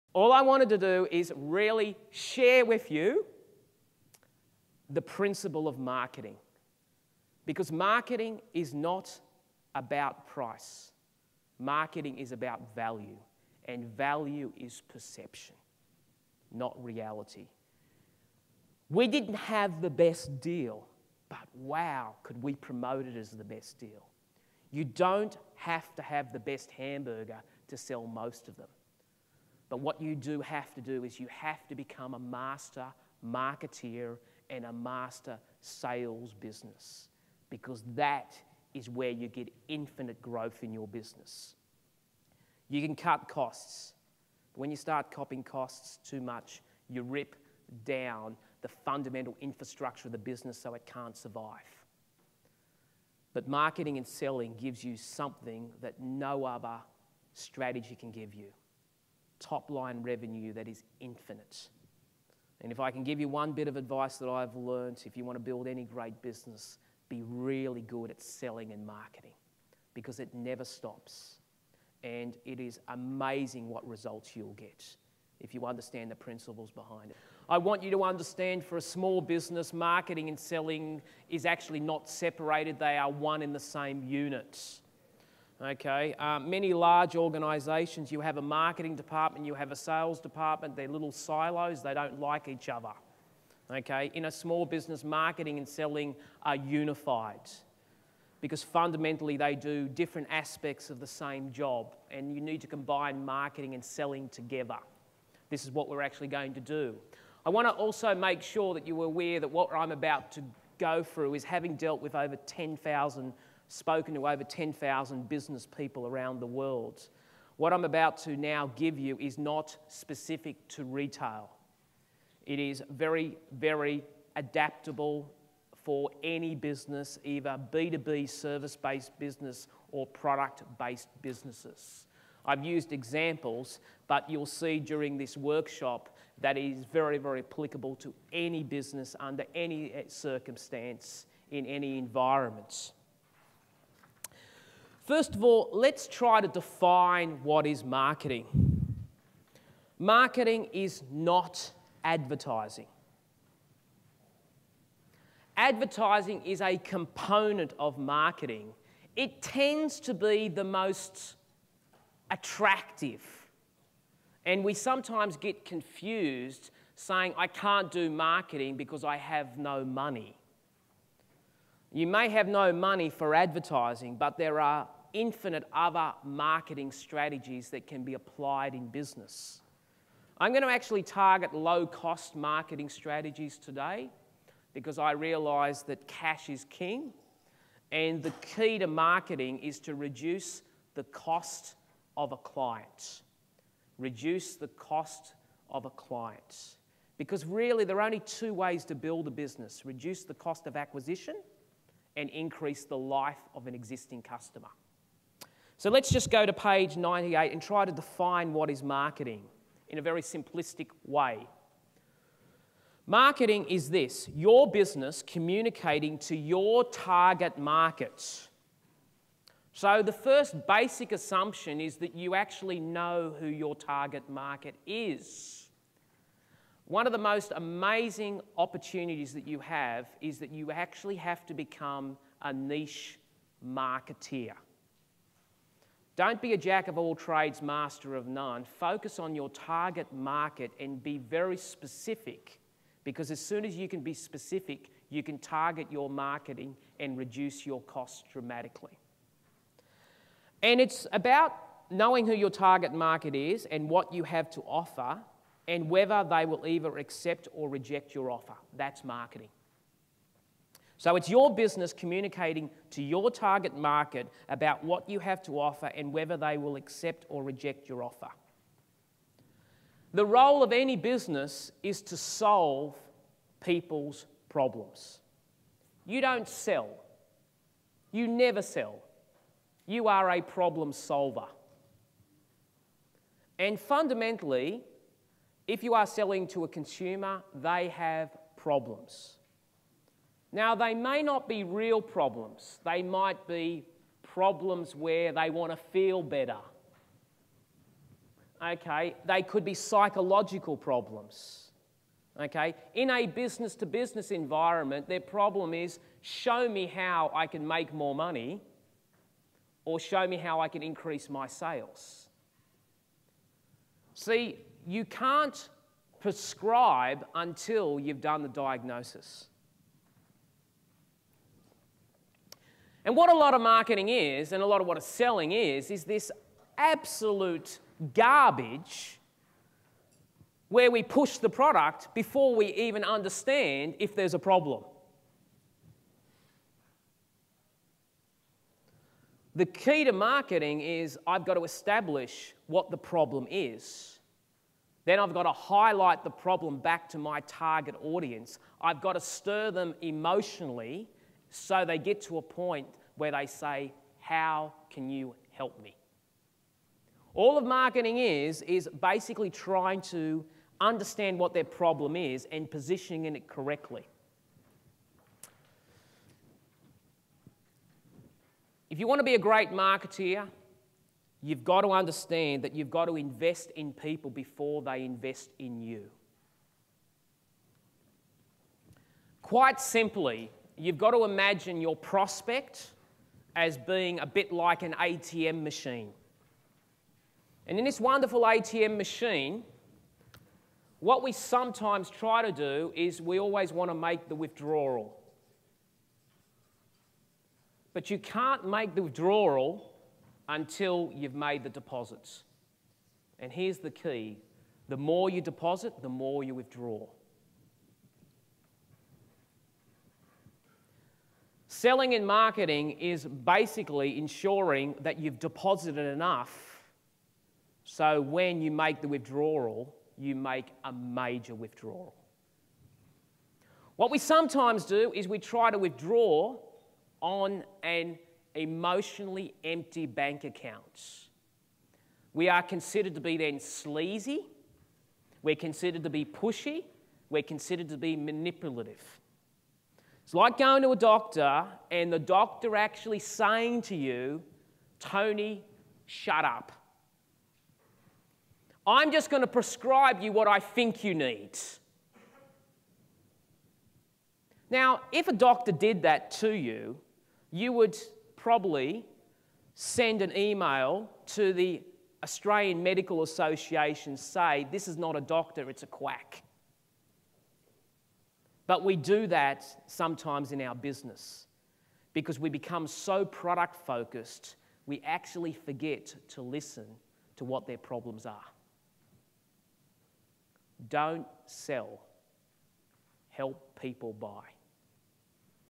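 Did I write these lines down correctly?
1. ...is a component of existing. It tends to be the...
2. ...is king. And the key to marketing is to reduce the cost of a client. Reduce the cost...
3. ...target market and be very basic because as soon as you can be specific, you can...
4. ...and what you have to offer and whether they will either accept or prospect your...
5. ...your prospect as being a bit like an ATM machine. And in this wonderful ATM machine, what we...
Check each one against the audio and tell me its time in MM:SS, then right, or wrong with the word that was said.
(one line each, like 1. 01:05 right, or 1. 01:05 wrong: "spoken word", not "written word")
1. 02:36 wrong: "marketing", not "existing"
2. 03:06 right
3. 03:59 wrong: "specific", not "basic"
4. 04:13 wrong: "reject", not "prospect"
5. 06:21 right.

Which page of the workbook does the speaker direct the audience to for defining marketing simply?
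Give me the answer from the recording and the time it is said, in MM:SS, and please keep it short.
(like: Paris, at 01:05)
98, at 03:26.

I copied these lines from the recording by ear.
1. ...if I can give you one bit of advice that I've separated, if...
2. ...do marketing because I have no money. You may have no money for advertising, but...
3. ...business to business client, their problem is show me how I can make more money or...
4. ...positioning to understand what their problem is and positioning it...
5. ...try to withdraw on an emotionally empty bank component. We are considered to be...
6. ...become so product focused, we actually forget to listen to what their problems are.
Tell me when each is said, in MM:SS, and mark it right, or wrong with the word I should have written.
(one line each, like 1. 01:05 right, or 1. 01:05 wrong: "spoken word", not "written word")
1. 01:02 wrong: "learned", not "separated"
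2. 02:47 right
3. 05:03 wrong: "environment", not "client"
4. 05:59 wrong: "trying", not "positioning"
5. 07:05 wrong: "account", not "component"
6. 07:52 right.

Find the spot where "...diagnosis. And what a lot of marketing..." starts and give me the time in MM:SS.
05:18.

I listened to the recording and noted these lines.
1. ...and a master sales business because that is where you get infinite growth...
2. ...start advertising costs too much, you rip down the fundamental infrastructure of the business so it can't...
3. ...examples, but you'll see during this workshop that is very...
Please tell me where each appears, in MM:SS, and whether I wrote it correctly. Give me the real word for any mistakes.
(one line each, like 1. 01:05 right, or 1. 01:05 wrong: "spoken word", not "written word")
1. 00:34 right
2. 00:44 wrong: "copying", not "advertising"
3. 02:12 right.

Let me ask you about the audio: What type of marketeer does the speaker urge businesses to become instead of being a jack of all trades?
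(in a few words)
Niche marketeer.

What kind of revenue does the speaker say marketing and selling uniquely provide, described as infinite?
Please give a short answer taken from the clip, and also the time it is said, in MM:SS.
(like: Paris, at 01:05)
Top line revenue, at 00:59.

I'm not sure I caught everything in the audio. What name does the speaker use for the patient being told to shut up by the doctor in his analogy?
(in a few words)
Tony.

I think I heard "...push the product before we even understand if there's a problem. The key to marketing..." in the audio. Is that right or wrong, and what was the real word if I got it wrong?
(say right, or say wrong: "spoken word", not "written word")
right.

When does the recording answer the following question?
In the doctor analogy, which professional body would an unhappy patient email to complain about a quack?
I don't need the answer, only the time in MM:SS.
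07:42.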